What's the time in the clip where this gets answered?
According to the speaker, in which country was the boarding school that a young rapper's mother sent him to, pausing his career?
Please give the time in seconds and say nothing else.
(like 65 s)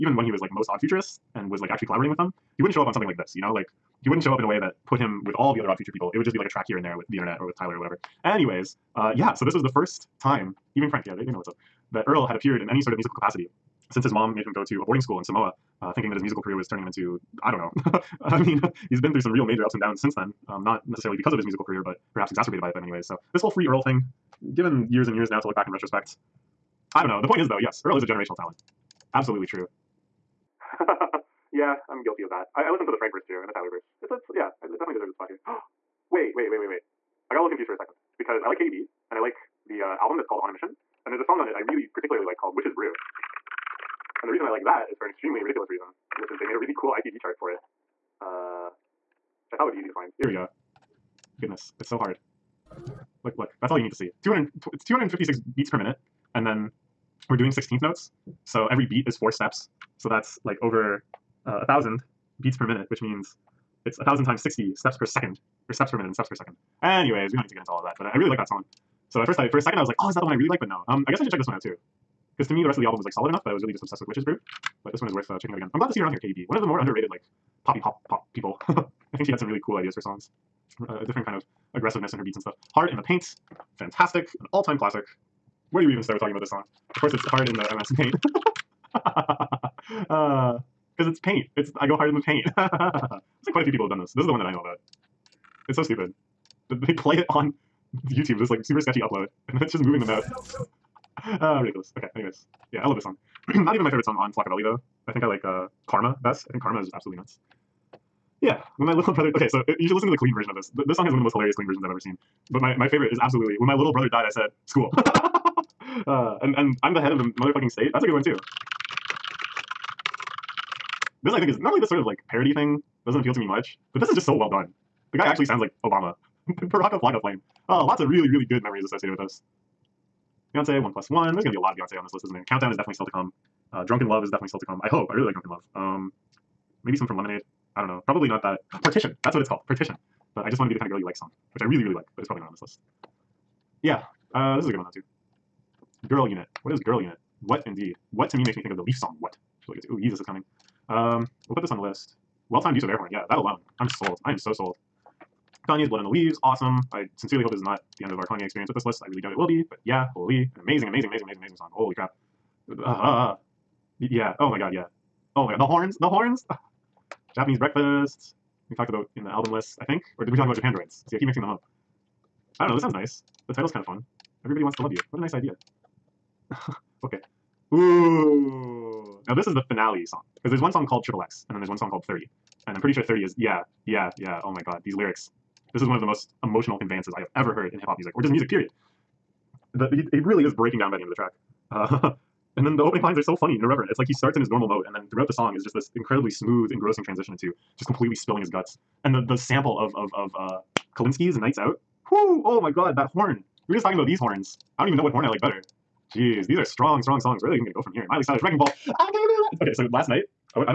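15 s.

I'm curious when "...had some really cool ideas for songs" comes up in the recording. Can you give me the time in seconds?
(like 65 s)
79 s.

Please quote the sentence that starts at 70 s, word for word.
Um, I guess I should check this one out too.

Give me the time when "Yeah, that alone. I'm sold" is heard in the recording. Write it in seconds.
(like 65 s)
153 s.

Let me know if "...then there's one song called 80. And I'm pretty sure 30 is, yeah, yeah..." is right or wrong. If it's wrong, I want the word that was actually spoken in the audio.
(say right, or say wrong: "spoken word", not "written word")
wrong: "30", not "80".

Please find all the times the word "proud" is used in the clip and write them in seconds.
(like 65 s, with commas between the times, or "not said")
not said.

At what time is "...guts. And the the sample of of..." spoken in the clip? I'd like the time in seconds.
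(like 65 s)
198 s.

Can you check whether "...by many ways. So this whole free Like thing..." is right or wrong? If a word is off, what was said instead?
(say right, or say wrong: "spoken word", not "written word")
wrong: "Earl", not "Like".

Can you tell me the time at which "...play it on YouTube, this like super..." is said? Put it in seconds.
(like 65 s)
96 s.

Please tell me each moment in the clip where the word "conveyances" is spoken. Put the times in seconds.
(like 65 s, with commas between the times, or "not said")
186 s.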